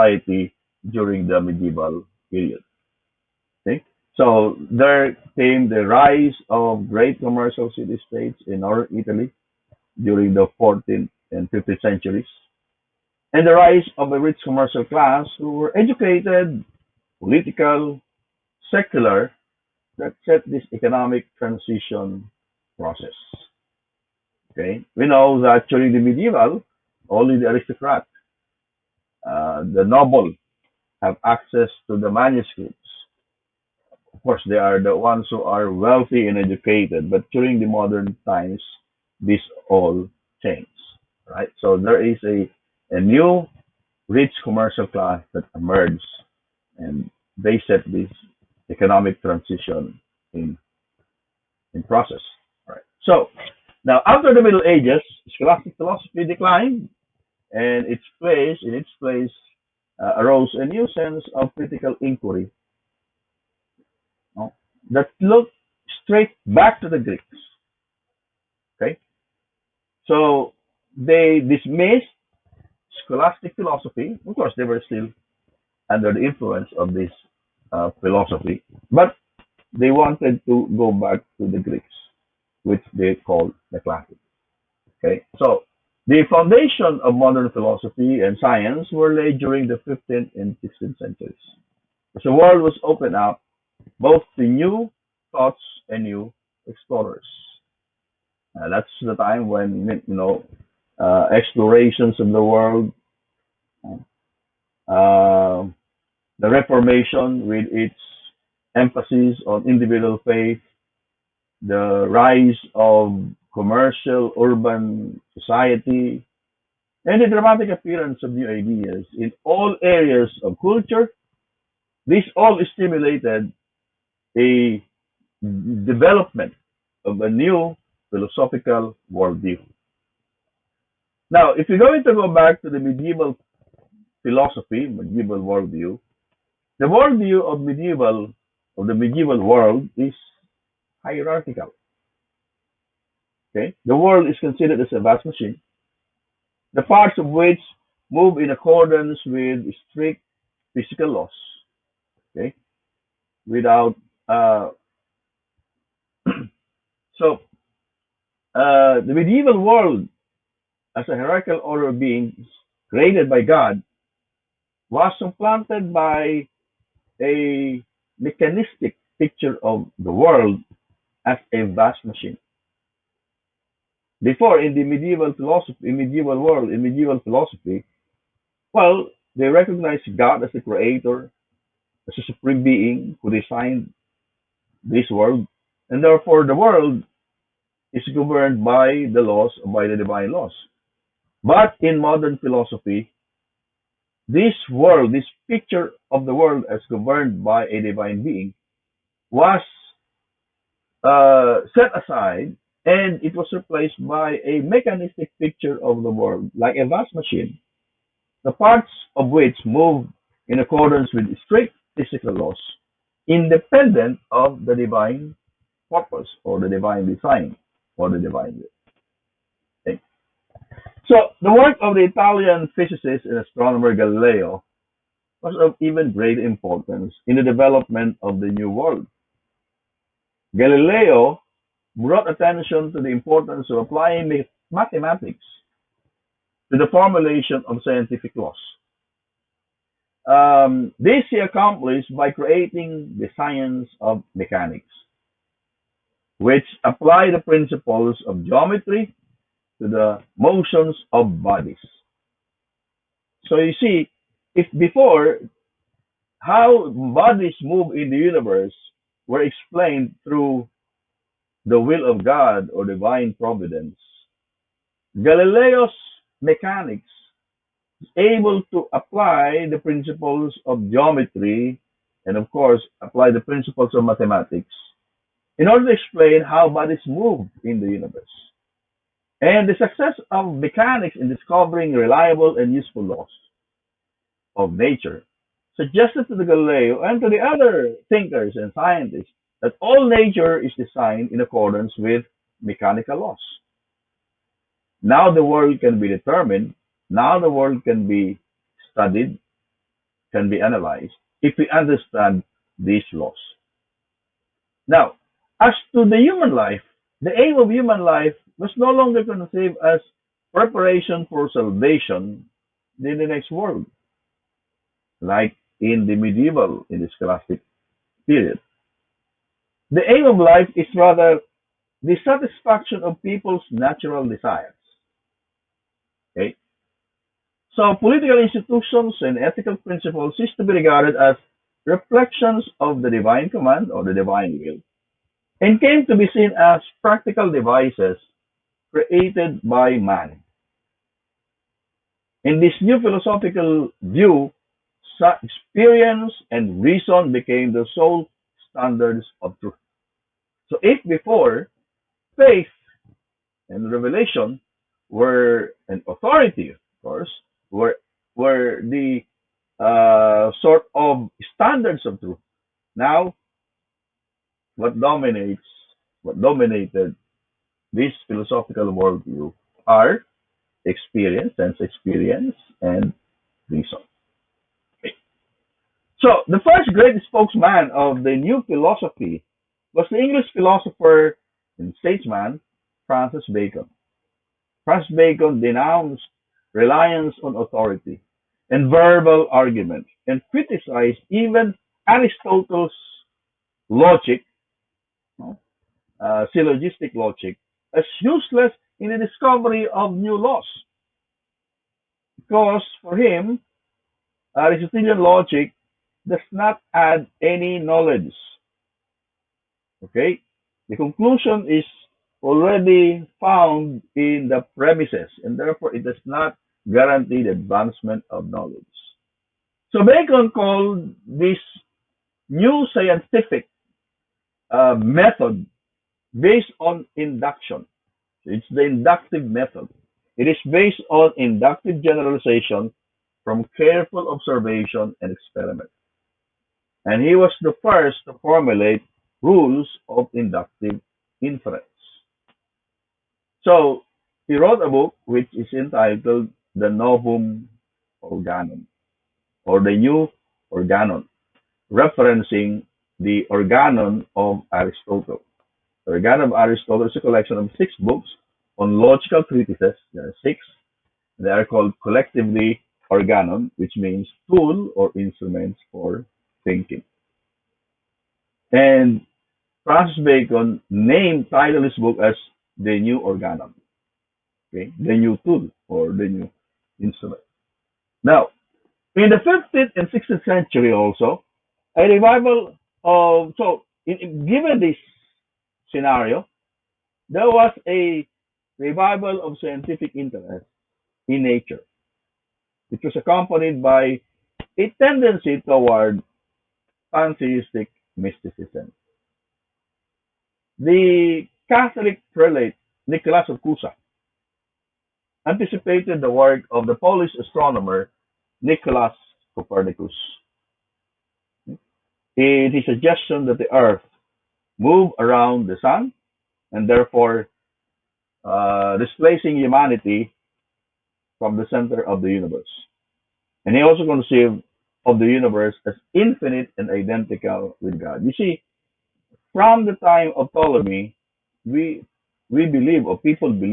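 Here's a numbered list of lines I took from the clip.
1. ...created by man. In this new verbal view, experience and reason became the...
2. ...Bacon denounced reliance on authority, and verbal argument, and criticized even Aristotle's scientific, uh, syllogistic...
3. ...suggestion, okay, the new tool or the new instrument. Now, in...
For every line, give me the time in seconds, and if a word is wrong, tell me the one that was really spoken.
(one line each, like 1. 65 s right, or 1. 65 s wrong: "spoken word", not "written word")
1. 338 s wrong: "philosophical", not "verbal"
2. 385 s wrong: "logic", not "scientific"
3. 473 s wrong: "organon", not "suggestion".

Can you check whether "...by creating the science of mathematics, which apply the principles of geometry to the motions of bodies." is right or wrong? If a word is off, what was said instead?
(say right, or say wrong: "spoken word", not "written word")
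wrong: "mechanics", not "mathematics".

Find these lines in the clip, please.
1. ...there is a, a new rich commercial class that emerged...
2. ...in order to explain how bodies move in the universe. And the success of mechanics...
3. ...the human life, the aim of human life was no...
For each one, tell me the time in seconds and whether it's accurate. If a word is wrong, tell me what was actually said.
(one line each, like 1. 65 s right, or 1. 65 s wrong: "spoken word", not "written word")
1. 41 s right
2. 275 s right
3. 306 s right.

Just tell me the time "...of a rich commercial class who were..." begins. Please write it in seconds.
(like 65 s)
13 s.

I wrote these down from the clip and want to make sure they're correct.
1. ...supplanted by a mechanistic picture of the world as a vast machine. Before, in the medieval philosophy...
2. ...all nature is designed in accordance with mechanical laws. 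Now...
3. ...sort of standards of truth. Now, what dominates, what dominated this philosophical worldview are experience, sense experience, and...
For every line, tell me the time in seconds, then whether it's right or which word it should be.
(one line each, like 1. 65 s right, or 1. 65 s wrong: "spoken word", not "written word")
1. 165 s right
2. 289 s right
3. 360 s right.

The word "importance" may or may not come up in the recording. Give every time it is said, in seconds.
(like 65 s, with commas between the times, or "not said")
226 s, 233 s.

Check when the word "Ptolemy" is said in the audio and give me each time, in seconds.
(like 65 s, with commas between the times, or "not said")
530 s.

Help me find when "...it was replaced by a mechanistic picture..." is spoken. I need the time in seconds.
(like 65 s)
203 s.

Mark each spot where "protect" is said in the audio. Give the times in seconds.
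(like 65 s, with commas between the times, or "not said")
not said.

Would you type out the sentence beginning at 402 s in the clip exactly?
Because for him, Aristotelian logic does not add any knowledge.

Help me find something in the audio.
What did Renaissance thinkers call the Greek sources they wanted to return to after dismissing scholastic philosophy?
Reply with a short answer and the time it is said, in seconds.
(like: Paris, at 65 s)
The classics, at 83 s.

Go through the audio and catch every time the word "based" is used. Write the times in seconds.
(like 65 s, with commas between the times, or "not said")
426 s, 430 s.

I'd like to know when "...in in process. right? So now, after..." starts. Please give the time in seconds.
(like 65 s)
50 s.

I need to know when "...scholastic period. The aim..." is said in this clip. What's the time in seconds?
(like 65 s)
317 s.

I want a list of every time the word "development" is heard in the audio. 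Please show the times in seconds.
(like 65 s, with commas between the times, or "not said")
125 s, 227 s.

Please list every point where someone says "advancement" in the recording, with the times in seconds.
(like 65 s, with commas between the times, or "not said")
417 s.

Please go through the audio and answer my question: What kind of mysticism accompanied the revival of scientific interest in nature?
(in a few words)
Pantheistic mysticism.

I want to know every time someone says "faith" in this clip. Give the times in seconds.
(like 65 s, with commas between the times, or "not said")
110 s, 352 s.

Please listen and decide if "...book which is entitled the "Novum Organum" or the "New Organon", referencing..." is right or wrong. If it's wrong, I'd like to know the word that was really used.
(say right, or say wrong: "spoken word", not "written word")
right.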